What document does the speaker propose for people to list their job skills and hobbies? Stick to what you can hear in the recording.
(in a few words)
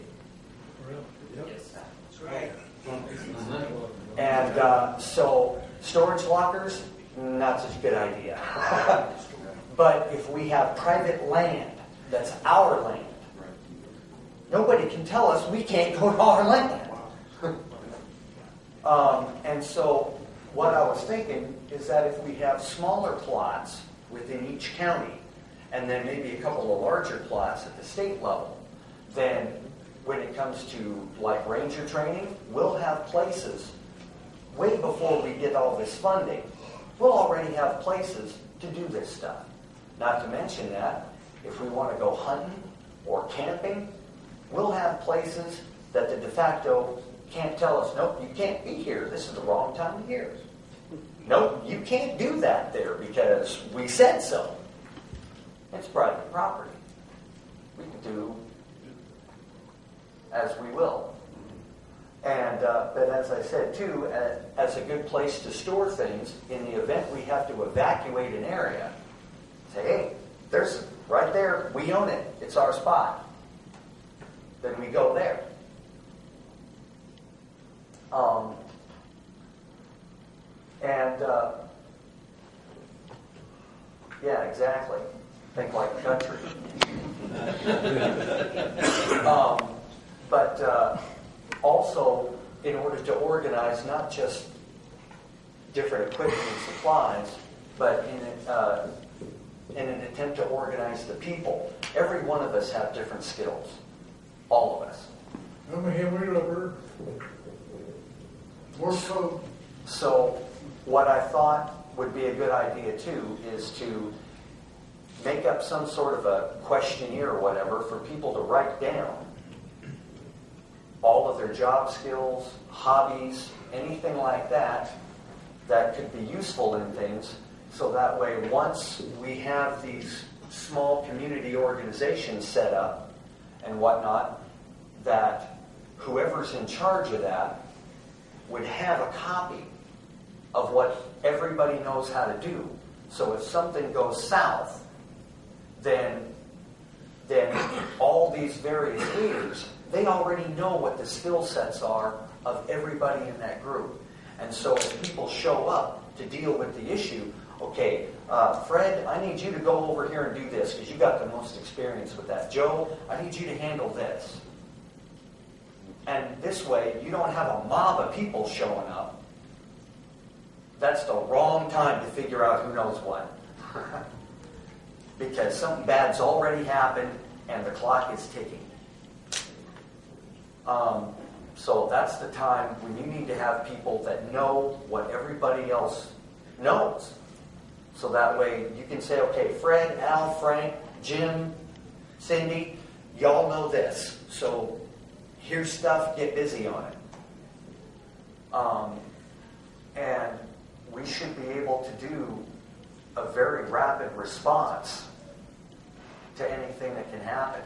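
A questionnaire.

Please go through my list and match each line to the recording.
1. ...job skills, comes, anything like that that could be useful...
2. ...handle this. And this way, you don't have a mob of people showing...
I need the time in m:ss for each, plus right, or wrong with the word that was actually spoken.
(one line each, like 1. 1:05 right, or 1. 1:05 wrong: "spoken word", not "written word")
1. 2:01 wrong: "hobbies", not "comes"
2. 2:43 right.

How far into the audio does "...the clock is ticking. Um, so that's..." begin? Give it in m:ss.
2:57.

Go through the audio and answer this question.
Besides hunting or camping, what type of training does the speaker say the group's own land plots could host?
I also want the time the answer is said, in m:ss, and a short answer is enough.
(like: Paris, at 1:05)
Ranger training, at 0:31.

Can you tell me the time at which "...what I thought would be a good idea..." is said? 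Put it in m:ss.
1:50.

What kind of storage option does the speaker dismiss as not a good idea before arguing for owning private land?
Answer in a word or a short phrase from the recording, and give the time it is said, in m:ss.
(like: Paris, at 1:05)
Storage lockers, at 0:05.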